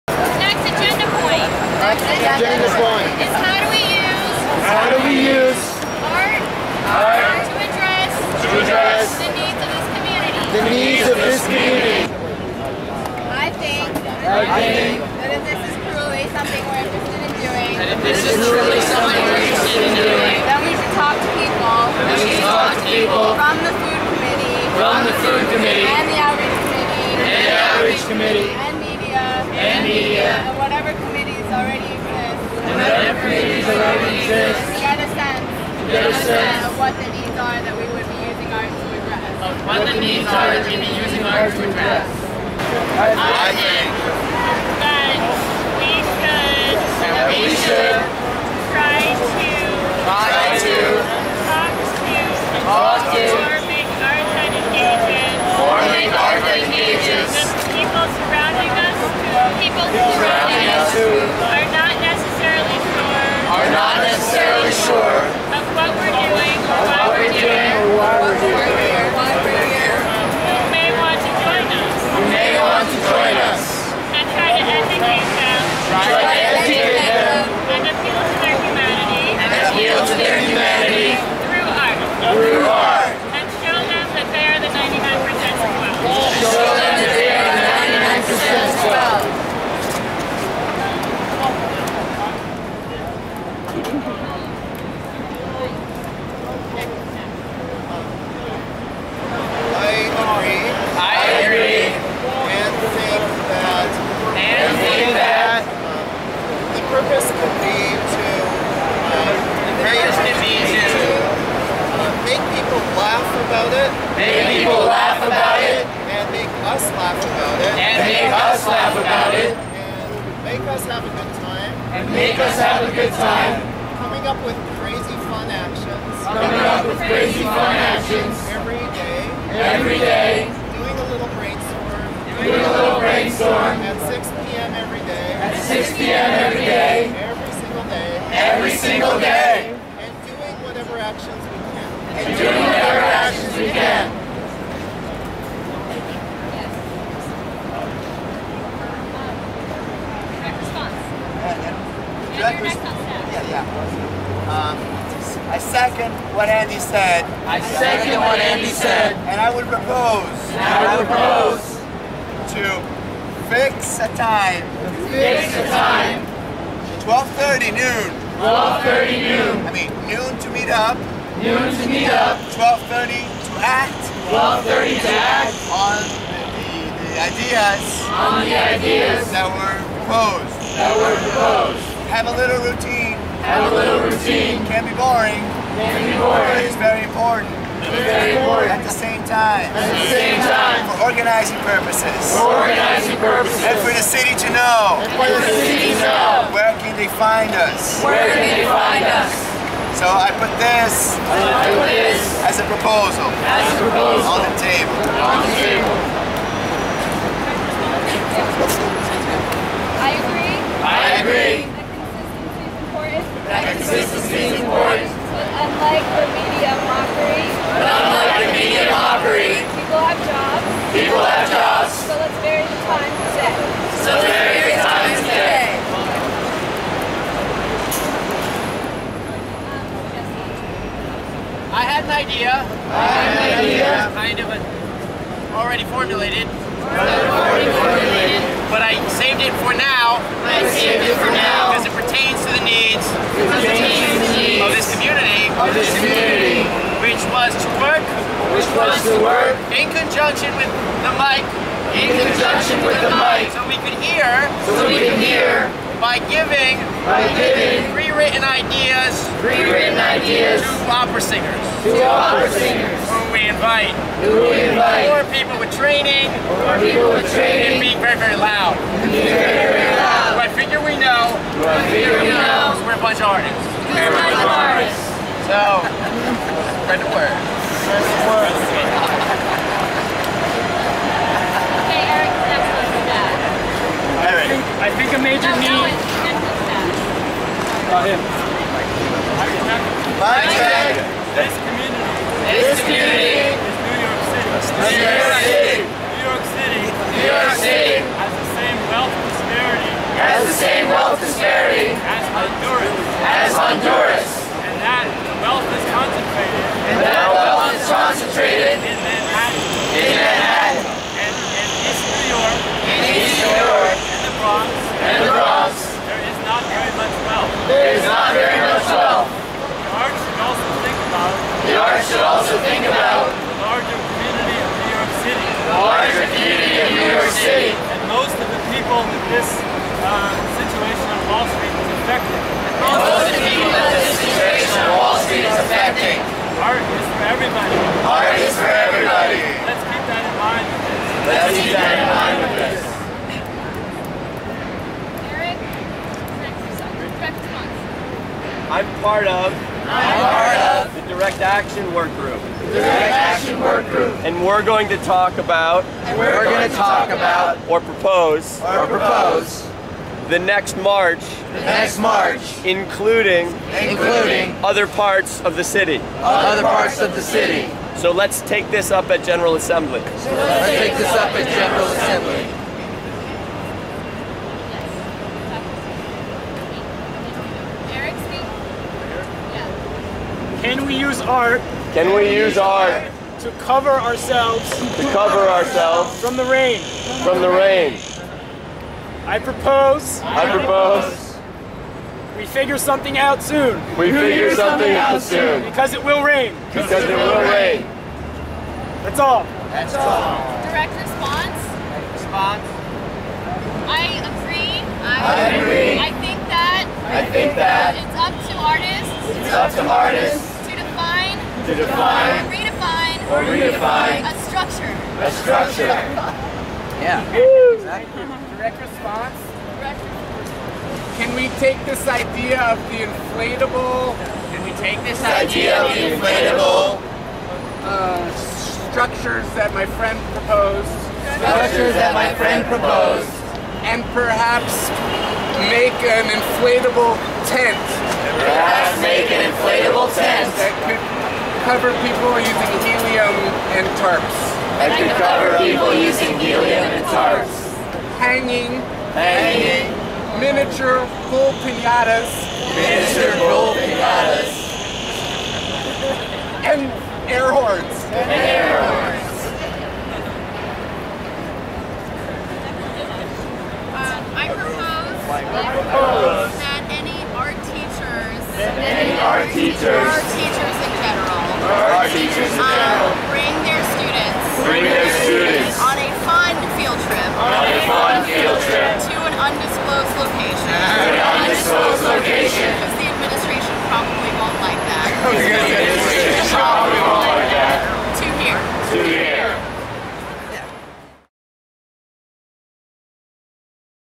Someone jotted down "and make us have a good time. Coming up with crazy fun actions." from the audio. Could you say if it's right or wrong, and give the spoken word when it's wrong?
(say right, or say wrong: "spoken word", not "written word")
right.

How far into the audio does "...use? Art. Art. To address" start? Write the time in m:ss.
0:05.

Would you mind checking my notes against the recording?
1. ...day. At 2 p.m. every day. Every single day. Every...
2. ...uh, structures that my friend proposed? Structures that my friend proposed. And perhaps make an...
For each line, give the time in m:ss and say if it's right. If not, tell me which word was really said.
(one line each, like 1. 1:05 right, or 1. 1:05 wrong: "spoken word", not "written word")
1. 2:15 wrong: "6", not "2"
2. 7:07 right.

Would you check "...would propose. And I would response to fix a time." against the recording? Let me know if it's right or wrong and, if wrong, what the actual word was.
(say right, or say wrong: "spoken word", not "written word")
wrong: "propose", not "response".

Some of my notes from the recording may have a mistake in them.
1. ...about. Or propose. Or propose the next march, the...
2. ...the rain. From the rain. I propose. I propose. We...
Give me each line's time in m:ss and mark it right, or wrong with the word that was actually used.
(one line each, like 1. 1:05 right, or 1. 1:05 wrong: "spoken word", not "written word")
1. 5:57 right
2. 6:26 right.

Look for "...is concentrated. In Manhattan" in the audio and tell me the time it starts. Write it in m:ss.
5:07.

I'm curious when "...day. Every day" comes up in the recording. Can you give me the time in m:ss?
2:08.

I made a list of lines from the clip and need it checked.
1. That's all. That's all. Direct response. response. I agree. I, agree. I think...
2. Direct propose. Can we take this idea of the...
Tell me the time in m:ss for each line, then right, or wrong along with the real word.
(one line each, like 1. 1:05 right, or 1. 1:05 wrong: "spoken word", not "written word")
1. 6:39 right
2. 6:58 wrong: "response", not "propose".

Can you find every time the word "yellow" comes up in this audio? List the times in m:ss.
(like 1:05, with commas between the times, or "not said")
not said.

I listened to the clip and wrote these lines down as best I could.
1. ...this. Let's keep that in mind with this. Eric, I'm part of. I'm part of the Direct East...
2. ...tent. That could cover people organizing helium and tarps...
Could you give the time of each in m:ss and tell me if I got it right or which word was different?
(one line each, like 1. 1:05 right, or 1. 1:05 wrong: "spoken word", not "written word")
1. 5:40 wrong: "Action", not "East"
2. 7:20 wrong: "using", not "organizing".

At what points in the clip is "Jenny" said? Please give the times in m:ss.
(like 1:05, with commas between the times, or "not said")
0:02.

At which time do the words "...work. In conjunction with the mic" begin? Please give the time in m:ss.
4:09.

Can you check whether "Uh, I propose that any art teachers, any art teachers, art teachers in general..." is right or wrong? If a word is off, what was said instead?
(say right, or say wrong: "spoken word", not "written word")
right.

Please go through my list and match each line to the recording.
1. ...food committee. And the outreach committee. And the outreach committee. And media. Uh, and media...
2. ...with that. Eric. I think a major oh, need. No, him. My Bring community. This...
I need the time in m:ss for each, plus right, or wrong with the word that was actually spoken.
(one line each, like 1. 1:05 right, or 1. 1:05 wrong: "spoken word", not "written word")
1. 0:25 right
2. 4:42 wrong: "This", not "Bring".